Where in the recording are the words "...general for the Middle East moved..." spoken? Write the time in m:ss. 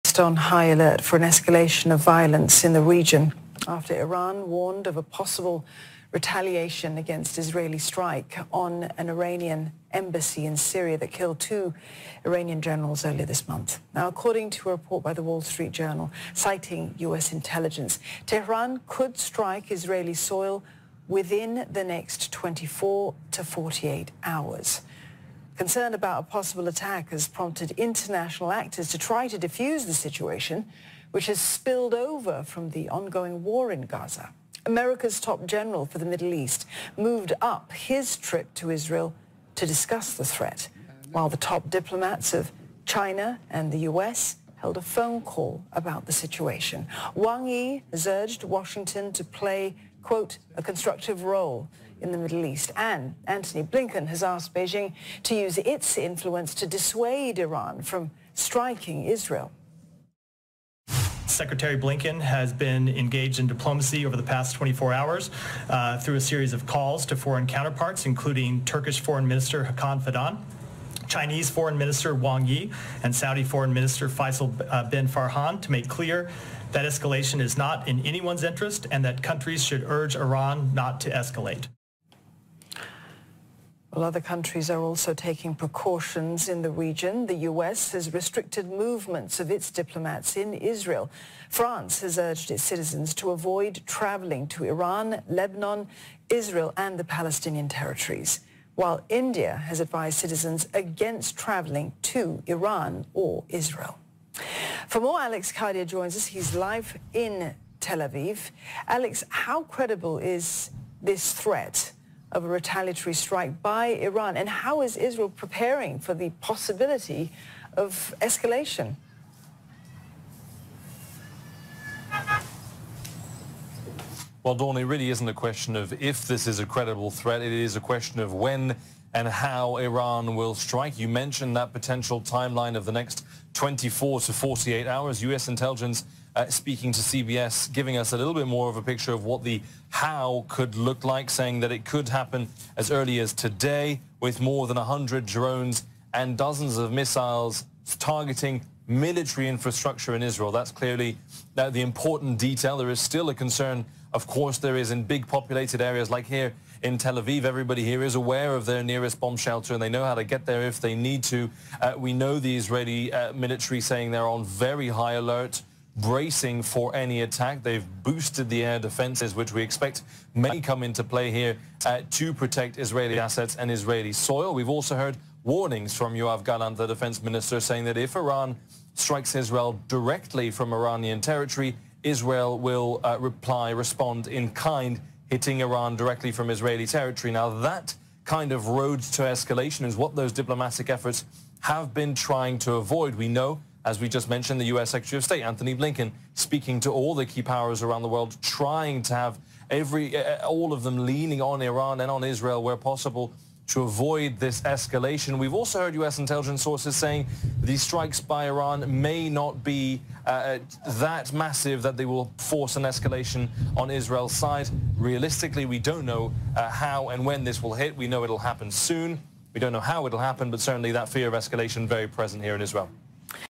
0:35.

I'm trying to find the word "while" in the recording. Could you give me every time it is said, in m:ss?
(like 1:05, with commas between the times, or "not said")
0:41, 1:38.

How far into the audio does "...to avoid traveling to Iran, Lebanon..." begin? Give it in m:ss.
1:33.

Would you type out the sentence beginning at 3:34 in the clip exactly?
Realistically, we don't know uh, how and when this will hit.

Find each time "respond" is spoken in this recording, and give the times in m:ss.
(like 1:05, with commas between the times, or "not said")
3:03.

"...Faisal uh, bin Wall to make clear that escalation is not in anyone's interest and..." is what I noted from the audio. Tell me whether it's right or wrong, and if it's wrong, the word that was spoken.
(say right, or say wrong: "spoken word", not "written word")
wrong: "Farhan", not "Wall".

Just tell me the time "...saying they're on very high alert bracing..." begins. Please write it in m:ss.
2:43.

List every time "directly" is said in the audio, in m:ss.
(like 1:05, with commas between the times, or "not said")
2:59, 3:05.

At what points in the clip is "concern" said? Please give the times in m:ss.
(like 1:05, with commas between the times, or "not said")
0:25, 2:33.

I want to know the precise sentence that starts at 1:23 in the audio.
Well, other countries are also taking precautions in the region.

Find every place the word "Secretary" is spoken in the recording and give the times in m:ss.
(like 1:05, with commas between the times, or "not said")
1:01, 3:14.